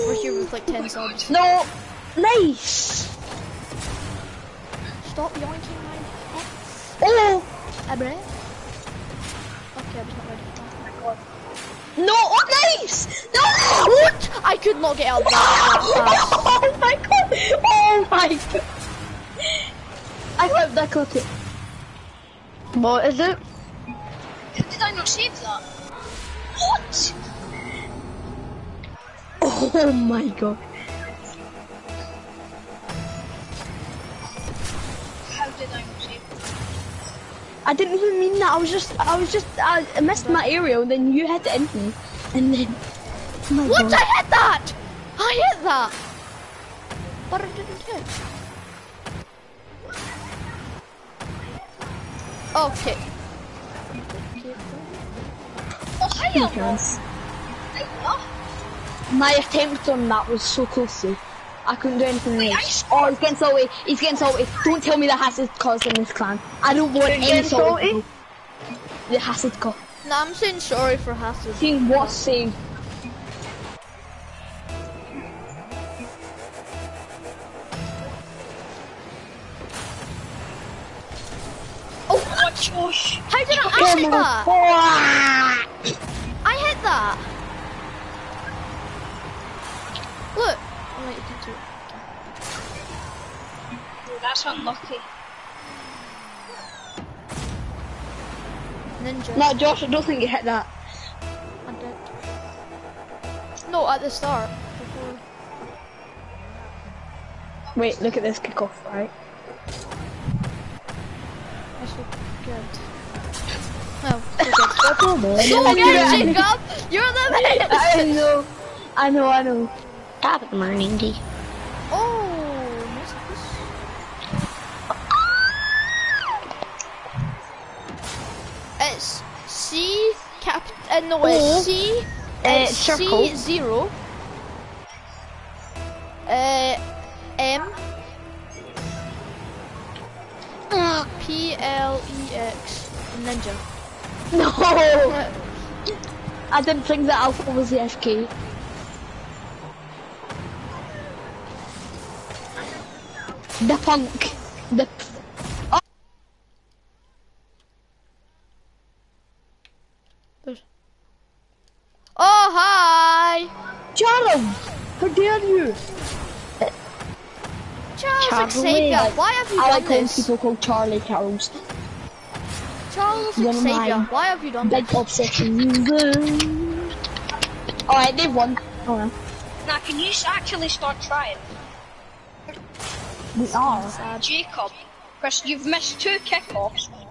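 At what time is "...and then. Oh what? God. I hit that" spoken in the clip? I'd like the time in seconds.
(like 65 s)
42 s.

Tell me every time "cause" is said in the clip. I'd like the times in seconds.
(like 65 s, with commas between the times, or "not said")
65 s, 69 s.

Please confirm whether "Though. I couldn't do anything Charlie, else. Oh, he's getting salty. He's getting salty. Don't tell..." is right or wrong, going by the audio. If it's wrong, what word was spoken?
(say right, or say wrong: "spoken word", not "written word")
wrong: "Wait", not "Charlie".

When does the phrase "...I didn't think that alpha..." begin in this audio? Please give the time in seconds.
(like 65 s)
146 s.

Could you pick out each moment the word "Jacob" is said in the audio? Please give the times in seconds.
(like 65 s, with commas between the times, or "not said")
116 s, 184 s.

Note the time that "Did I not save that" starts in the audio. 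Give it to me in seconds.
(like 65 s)
24 s.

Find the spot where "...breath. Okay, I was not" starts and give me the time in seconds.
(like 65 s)
7 s.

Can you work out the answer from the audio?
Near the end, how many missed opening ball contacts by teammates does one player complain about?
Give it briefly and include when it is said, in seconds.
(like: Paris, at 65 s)
2, at 185 s.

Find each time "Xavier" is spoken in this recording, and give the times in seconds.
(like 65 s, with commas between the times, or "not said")
168 s, 173 s.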